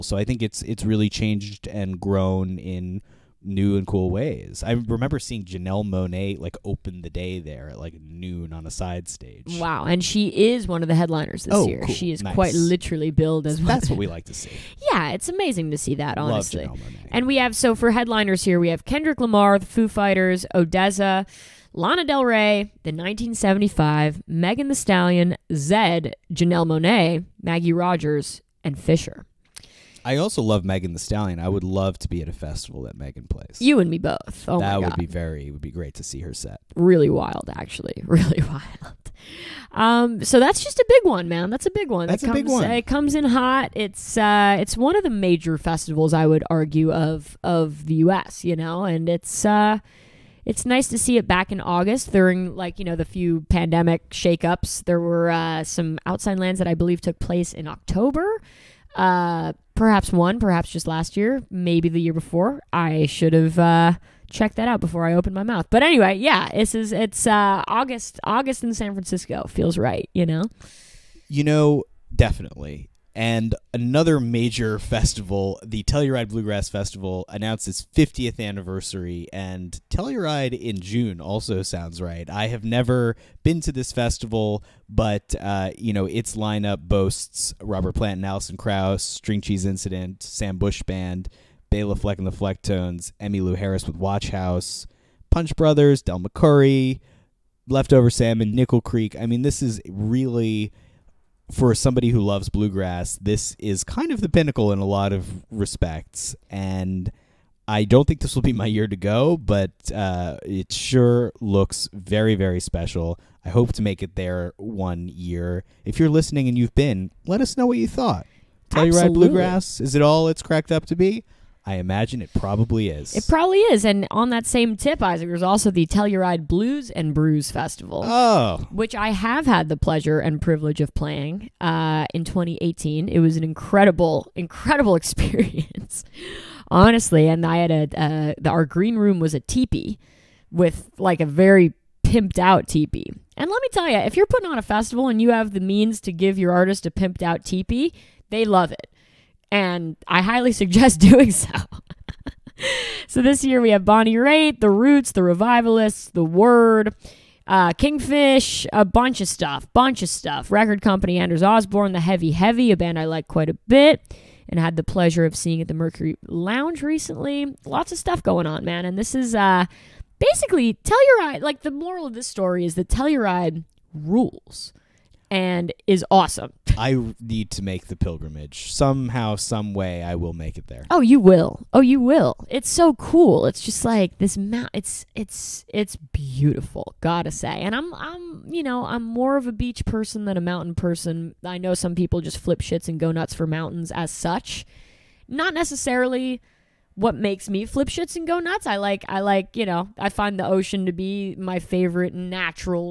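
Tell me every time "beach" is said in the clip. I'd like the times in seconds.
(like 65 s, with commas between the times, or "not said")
189 s.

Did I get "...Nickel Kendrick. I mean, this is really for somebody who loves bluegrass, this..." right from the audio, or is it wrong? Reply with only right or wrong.
wrong.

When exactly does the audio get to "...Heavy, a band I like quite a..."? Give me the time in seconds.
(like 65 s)
162 s.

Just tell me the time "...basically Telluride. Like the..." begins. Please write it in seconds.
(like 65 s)
170 s.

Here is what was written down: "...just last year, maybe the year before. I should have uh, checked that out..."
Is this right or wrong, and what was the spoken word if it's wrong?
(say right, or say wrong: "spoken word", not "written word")
right.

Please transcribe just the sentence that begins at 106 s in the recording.
And I don't think this will be my year to go, but uh, it sure looks very, very special.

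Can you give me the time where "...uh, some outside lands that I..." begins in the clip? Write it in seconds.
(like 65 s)
55 s.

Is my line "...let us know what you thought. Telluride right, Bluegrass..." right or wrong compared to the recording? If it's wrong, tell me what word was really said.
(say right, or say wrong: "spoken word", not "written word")
right.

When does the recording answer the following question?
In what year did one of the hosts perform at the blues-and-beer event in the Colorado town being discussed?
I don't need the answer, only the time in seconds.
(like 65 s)
132 s.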